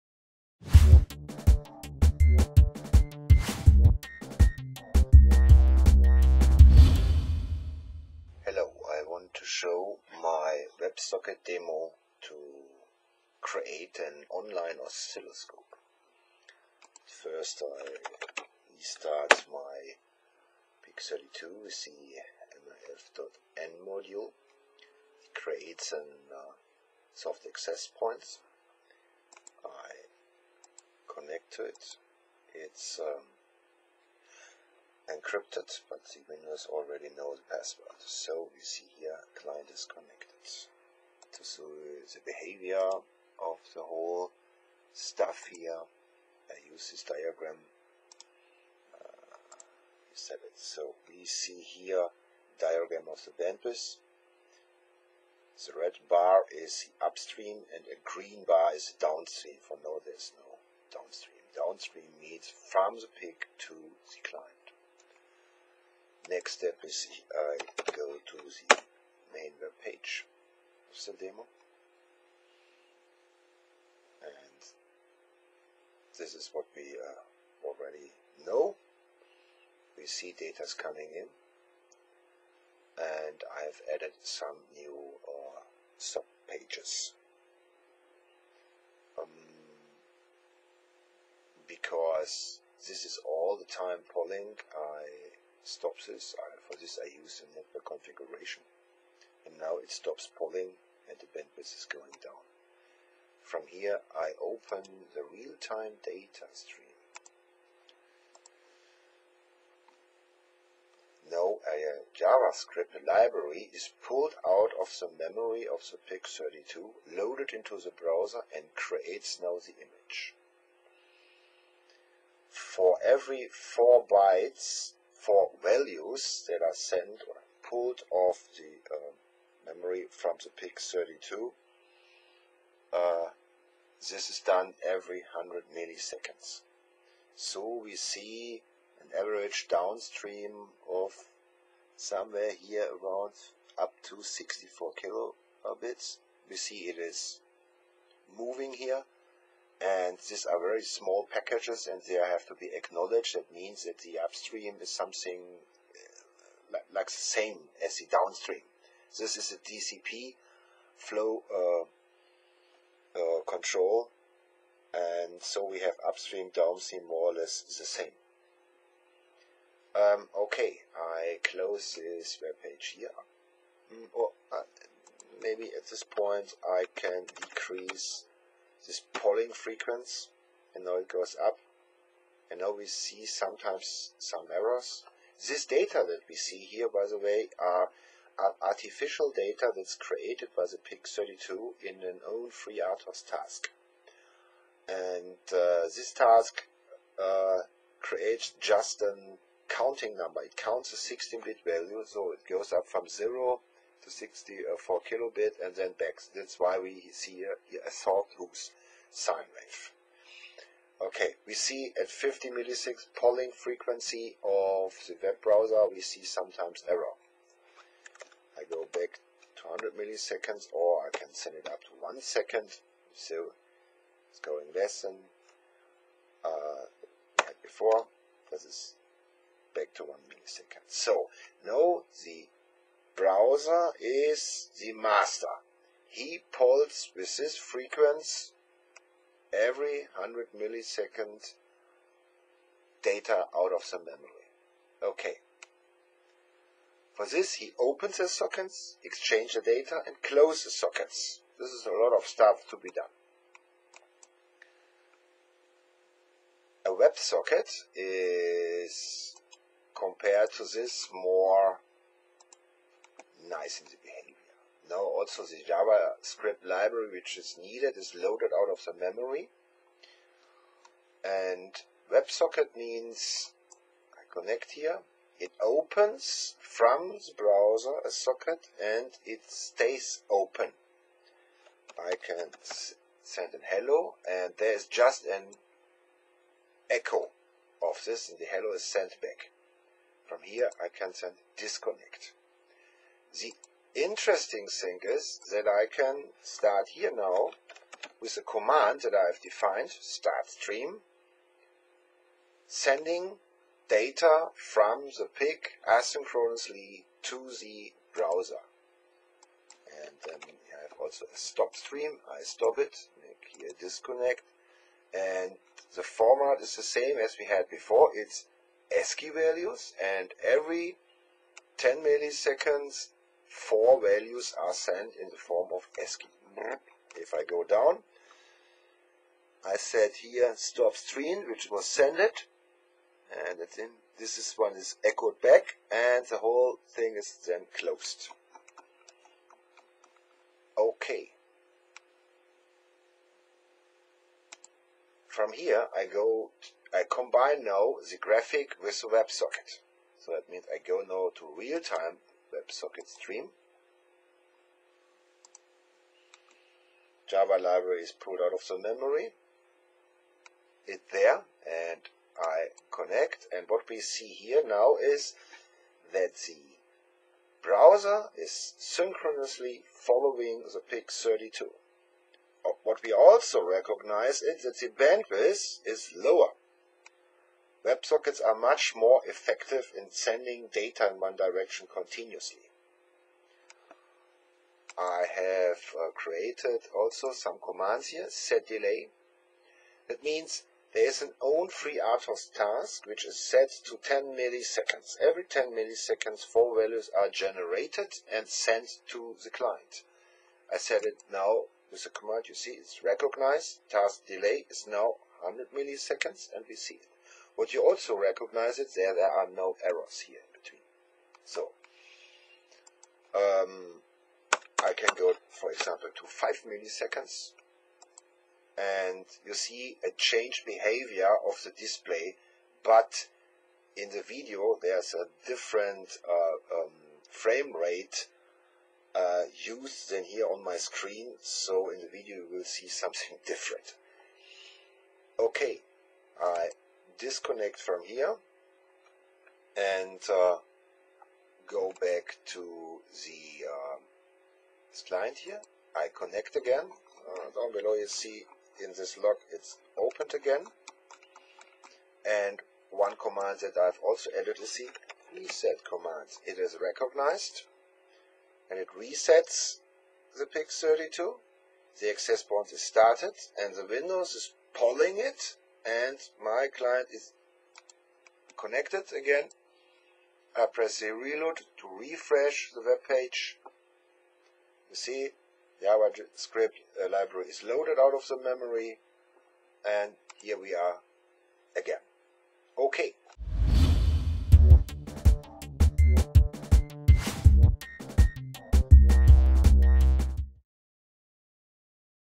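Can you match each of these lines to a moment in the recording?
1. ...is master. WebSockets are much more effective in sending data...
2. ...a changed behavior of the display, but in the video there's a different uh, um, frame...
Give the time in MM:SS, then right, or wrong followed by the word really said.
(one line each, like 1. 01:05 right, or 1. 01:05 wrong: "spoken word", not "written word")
1. 06:15 wrong: "lower", not "master"
2. 07:00 right.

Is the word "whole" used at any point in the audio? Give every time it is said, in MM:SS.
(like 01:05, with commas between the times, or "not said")
00:43, 05:36.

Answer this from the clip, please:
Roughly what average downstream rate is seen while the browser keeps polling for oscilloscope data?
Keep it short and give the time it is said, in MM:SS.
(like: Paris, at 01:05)
Up to 64 kilobits, at 02:23.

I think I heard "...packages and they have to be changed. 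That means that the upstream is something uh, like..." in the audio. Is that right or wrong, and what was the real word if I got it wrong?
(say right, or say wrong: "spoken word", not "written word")
wrong: "acknowledged", not "changed".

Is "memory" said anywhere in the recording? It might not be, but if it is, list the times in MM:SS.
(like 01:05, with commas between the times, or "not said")
01:55, 02:09, 04:03, 04:28, 05:58, 07:58.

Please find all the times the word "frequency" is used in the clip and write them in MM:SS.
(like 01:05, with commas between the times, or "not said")
02:59, 03:33, 03:57.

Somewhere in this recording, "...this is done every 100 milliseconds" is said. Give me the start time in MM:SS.
02:14.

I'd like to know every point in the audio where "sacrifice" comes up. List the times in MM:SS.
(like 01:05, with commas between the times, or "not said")
not said.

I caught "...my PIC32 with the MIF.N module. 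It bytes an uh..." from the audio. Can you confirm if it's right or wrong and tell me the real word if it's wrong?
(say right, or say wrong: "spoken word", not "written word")
wrong: "creates", not "bytes".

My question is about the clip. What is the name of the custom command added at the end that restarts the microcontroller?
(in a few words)
Reset.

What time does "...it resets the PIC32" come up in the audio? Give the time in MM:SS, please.
07:38.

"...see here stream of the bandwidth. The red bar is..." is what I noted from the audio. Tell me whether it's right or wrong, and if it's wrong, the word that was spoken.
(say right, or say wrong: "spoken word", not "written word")
wrong: "diagram", not "stream".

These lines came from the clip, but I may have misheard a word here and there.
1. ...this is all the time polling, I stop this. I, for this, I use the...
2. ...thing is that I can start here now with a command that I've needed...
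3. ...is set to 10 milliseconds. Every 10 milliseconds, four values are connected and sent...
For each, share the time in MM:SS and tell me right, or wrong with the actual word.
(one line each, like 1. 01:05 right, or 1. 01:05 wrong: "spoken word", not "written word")
1. 01:32 right
2. 04:54 wrong: "defined", not "needed"
3. 06:33 wrong: "generated", not "connected".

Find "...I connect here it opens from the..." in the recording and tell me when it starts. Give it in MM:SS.
04:34.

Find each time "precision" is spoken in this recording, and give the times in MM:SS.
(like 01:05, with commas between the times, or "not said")
not said.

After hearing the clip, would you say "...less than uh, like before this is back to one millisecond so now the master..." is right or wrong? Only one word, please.
wrong.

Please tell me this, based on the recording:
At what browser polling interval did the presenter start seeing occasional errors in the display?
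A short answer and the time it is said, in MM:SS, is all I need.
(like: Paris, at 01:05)
50 milliseconds, at 03:32.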